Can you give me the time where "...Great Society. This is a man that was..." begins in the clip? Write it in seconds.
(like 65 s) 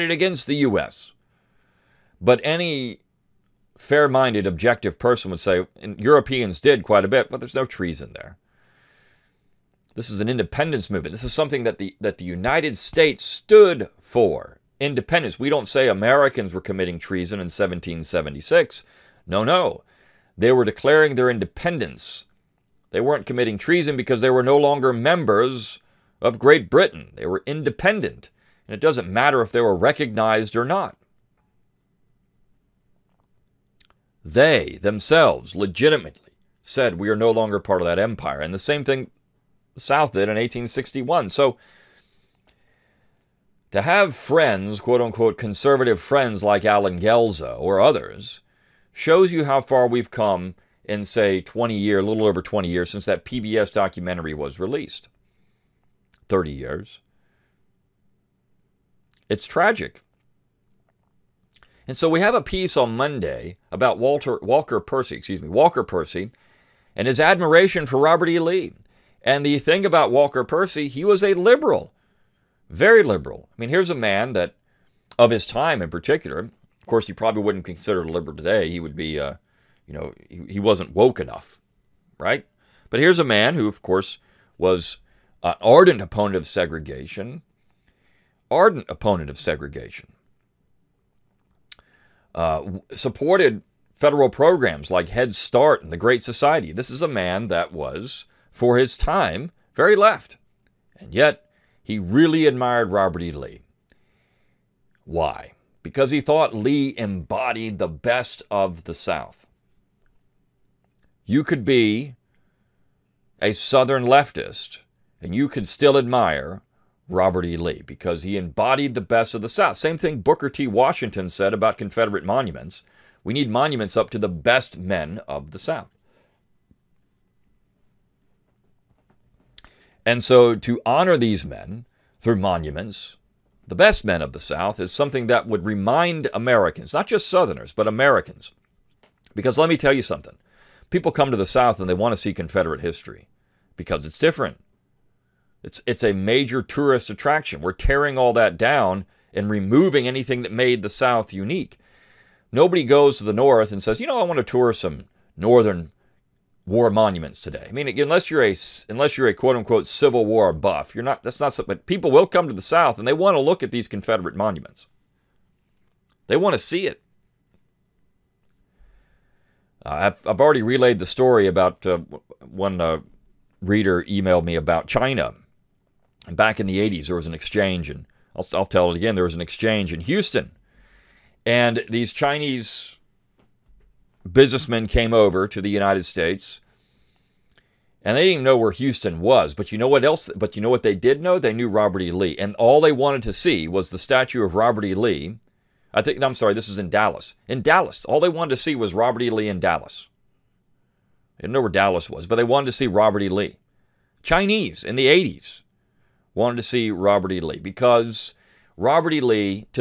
95 s.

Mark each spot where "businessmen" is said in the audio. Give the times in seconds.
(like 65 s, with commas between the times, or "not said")
184 s.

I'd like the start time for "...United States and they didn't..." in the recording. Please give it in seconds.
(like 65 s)
185 s.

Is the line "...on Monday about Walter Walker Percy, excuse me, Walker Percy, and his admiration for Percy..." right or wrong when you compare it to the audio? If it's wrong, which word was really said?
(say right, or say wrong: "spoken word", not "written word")
wrong: "Robert", not "Percy".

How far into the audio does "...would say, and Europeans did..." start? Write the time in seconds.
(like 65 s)
5 s.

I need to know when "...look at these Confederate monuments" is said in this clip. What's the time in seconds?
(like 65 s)
163 s.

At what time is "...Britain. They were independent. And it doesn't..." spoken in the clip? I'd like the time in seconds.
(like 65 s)
26 s.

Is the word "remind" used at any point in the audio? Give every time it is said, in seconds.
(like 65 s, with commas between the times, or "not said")
135 s.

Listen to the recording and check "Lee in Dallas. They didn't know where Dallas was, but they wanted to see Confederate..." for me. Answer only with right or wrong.
wrong.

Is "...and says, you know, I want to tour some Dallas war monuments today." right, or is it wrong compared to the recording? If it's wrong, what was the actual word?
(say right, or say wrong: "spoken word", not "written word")
wrong: "Northern", not "Dallas".